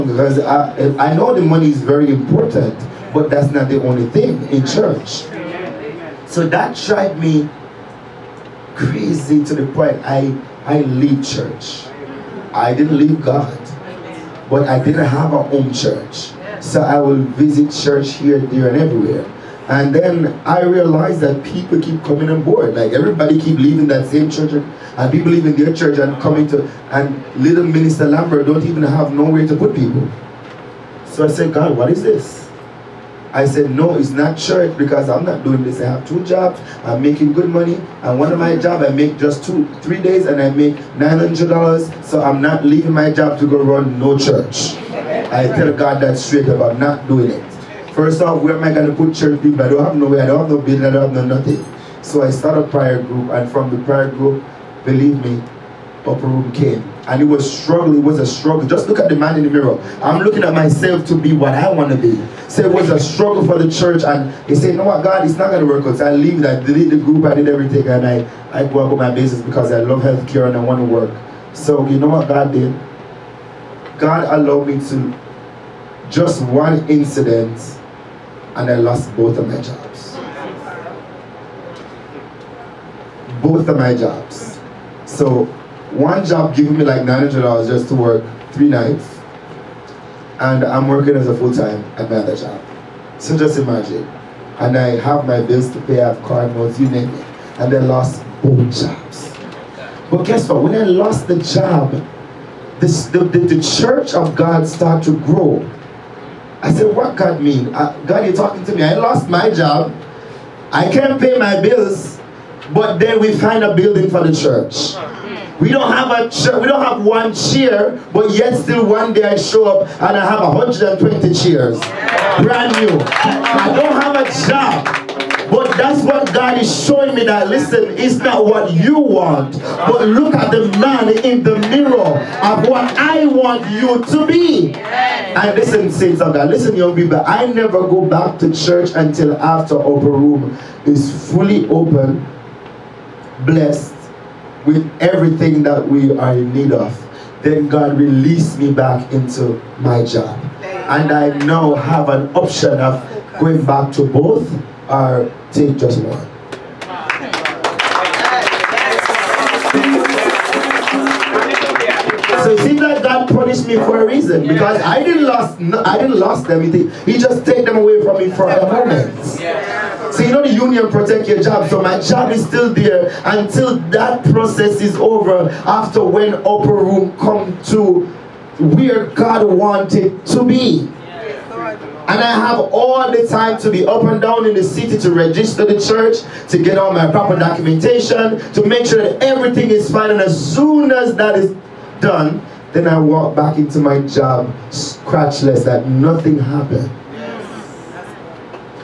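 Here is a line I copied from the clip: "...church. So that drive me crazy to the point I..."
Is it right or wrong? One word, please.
right.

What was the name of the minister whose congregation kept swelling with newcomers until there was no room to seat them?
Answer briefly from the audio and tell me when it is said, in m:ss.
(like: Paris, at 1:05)
Lambert, at 0:28.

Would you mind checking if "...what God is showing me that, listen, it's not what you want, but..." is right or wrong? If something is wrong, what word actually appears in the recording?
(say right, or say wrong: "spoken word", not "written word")
right.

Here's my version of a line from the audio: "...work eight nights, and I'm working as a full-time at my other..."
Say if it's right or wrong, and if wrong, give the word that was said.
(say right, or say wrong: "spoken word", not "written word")
wrong: "three", not "eight".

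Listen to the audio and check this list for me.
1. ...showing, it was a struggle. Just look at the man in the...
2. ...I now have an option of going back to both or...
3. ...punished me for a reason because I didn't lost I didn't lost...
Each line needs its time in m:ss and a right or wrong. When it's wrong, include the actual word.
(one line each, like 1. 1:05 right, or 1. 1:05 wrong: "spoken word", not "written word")
1. 0:57 wrong: "struggling", not "showing"
2. 2:31 right
3. 2:43 right.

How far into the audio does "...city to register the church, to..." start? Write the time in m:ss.
3:04.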